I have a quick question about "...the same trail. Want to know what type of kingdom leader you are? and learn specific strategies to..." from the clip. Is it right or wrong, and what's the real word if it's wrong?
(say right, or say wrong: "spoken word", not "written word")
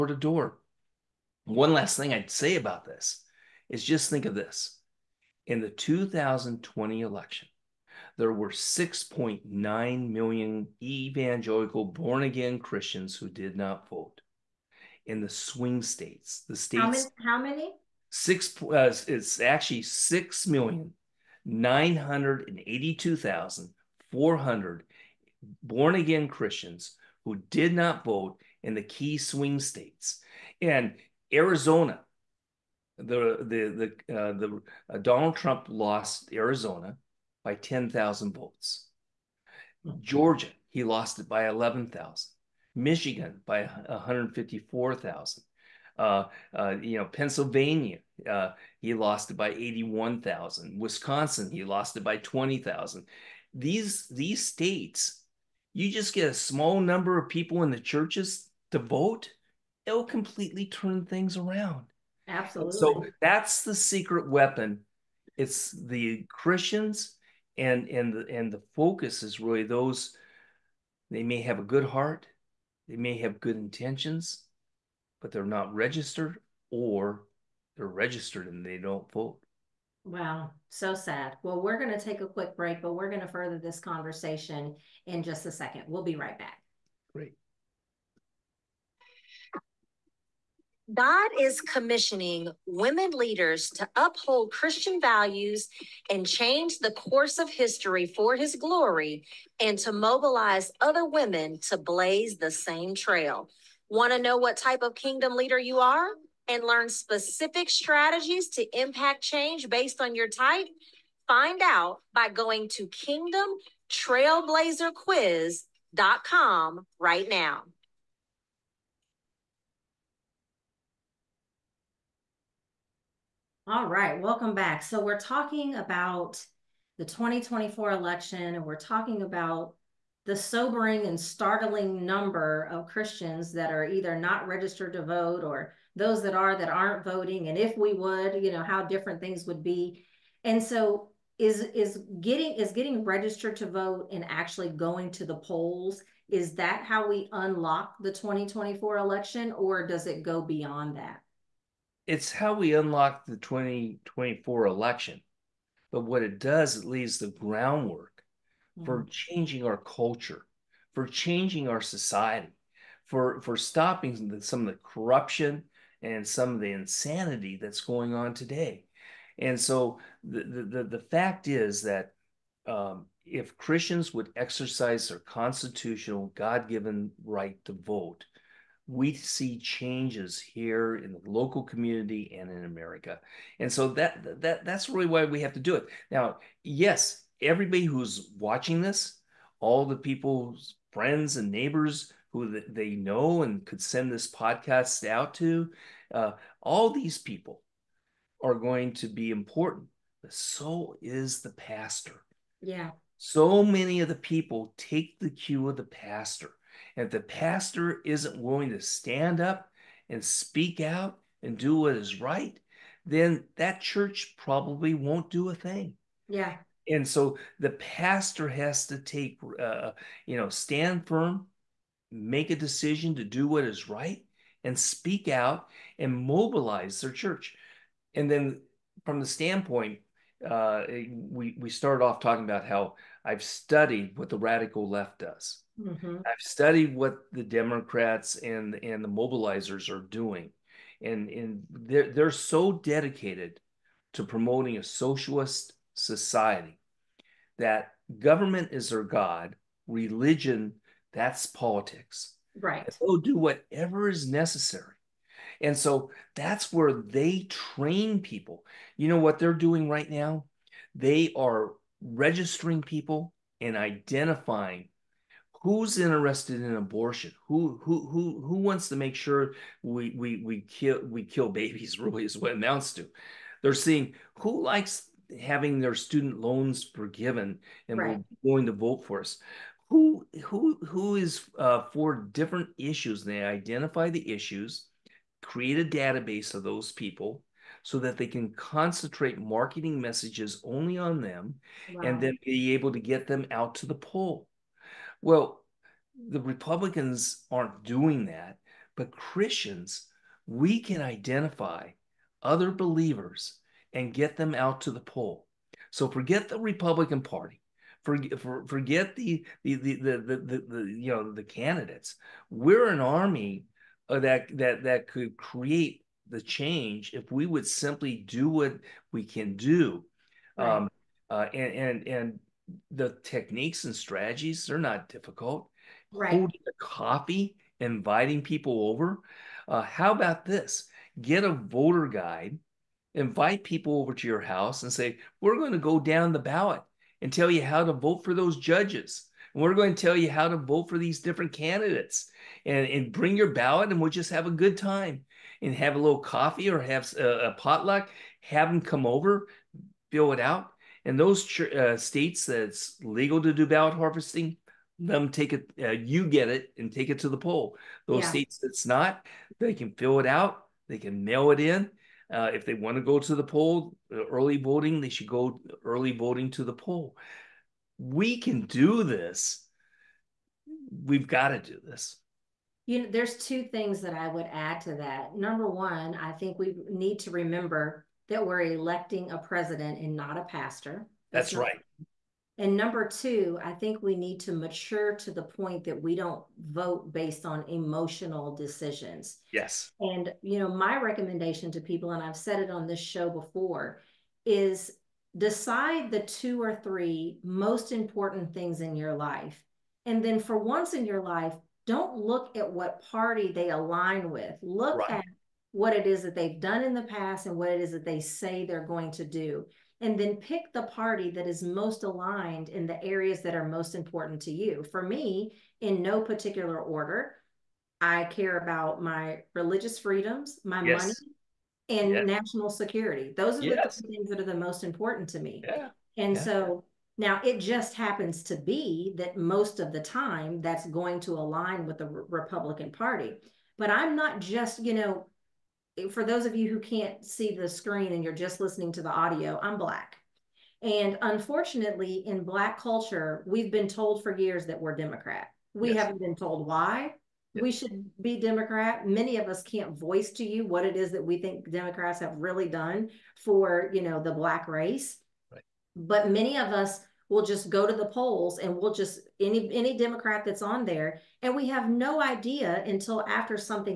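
right.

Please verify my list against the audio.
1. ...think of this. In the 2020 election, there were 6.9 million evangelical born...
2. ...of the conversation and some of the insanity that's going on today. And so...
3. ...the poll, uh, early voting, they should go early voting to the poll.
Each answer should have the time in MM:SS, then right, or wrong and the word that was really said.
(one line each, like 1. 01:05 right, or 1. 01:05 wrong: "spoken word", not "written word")
1. 00:04 right
2. 02:44 wrong: "corruption", not "conversation"
3. 06:03 right.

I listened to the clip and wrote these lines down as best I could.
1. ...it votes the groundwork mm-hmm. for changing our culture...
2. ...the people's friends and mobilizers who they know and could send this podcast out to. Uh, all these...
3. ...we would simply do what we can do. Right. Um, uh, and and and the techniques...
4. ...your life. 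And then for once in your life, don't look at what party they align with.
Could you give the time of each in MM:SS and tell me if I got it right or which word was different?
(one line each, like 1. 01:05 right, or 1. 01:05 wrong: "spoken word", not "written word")
1. 02:36 wrong: "leaves", not "votes"
2. 03:09 wrong: "neighbors", not "mobilizers"
3. 05:17 right
4. 06:38 right.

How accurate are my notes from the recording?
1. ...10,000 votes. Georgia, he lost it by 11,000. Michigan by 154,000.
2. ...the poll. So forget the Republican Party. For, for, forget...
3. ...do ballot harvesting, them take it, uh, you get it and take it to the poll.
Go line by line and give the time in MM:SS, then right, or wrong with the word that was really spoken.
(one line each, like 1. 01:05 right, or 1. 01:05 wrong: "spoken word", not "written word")
1. 00:37 right
2. 05:04 right
3. 05:53 right.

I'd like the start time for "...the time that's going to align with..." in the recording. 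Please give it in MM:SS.
07:09.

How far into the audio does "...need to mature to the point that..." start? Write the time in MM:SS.
06:24.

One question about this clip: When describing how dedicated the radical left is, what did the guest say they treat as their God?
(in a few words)
government.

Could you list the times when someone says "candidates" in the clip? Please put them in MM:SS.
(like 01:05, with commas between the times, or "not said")
05:11, 05:41.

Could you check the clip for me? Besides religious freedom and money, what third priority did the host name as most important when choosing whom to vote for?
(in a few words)
national security.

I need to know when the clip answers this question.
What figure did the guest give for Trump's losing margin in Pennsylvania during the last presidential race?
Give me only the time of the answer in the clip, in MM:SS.
00:49.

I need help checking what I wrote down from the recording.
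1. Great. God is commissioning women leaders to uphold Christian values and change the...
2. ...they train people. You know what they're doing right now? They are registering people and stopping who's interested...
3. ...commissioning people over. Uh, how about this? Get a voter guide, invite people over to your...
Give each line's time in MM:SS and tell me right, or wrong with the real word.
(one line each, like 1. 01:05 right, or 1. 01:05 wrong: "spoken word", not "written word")
1. 01:27 right
2. 04:16 wrong: "identifying", not "stopping"
3. 05:27 wrong: "inviting", not "commissioning".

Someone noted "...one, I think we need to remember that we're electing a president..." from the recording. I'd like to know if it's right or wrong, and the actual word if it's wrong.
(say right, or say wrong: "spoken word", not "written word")
right.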